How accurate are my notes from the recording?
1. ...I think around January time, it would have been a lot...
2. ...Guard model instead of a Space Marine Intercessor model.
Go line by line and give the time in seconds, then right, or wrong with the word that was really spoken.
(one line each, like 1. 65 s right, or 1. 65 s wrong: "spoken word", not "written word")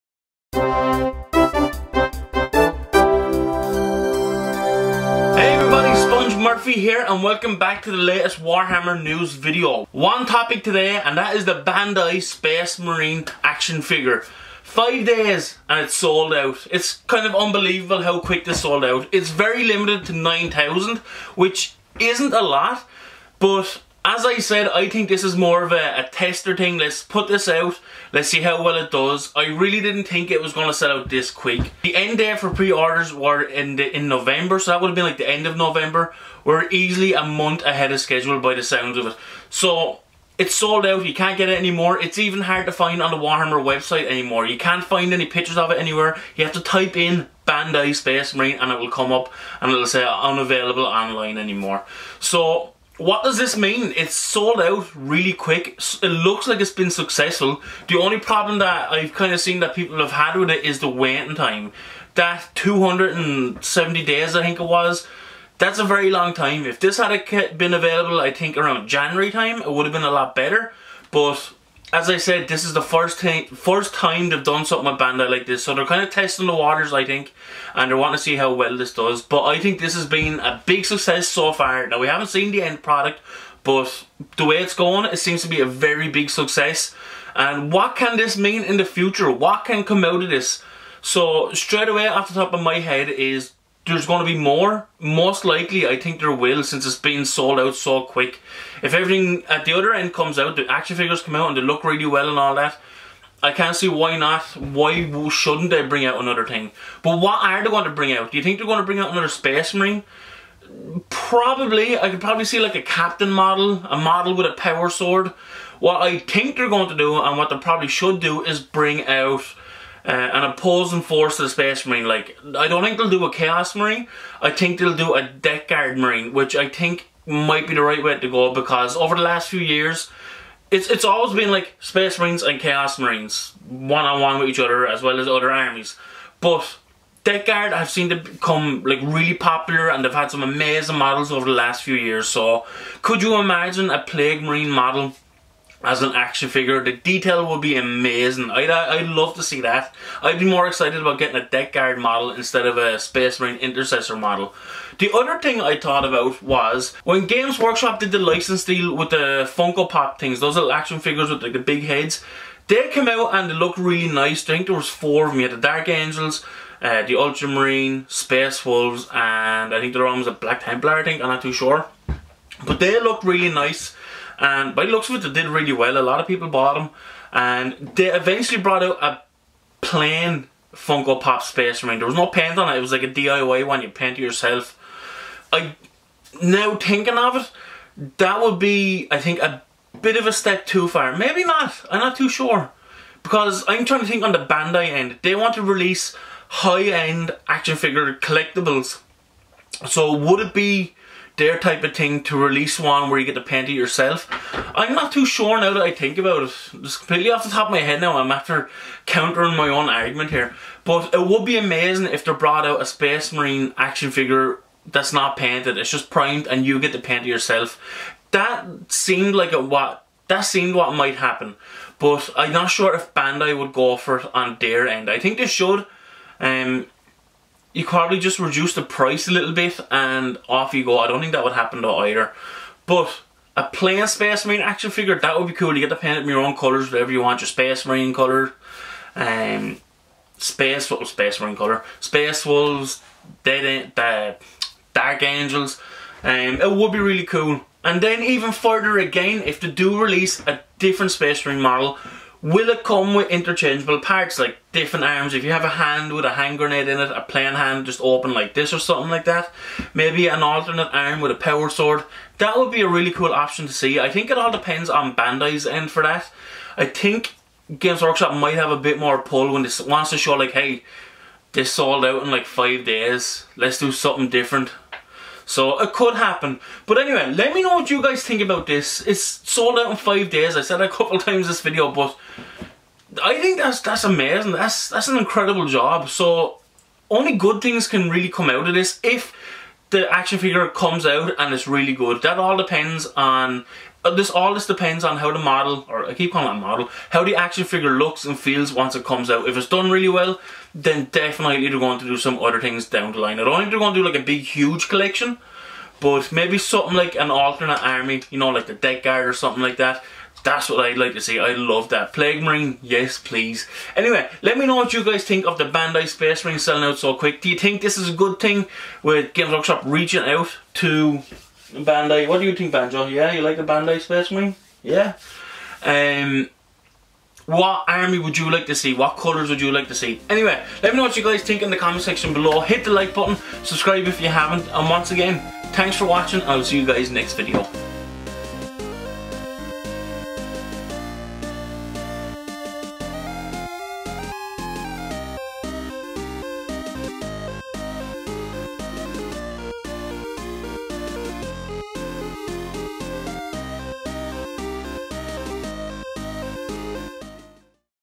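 1. 68 s right
2. 151 s right.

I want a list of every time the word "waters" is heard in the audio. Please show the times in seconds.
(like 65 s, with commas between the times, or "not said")
76 s.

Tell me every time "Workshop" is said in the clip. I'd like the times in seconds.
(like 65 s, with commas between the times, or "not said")
157 s, 268 s, 319 s.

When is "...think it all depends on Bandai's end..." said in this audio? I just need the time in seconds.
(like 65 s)
264 s.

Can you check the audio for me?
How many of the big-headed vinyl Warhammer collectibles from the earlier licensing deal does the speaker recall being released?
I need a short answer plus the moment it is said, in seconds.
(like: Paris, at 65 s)
4, at 164 s.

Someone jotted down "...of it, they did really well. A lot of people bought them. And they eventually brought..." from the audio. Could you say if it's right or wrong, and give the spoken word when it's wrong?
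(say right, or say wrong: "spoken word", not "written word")
right.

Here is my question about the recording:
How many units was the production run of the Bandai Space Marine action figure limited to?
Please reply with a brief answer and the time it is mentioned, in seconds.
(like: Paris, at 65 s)
9,000, at 20 s.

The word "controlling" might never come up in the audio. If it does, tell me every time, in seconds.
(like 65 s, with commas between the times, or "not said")
not said.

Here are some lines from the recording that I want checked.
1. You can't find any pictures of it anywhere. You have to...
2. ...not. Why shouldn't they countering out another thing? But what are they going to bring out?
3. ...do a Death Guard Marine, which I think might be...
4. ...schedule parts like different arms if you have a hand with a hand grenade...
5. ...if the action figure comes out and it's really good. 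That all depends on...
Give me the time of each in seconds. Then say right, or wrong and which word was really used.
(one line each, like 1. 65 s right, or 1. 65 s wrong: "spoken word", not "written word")
1. 44 s right
2. 104 s wrong: "bring", not "countering"
3. 124 s right
4. 253 s wrong: "interchangeable", not "schedule"
5. 289 s right.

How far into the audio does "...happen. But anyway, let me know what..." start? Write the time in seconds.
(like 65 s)
276 s.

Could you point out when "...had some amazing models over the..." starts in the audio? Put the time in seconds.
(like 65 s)
140 s.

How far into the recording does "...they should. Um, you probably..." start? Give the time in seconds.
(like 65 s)
225 s.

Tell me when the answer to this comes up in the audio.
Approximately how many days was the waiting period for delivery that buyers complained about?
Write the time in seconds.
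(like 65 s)
62 s.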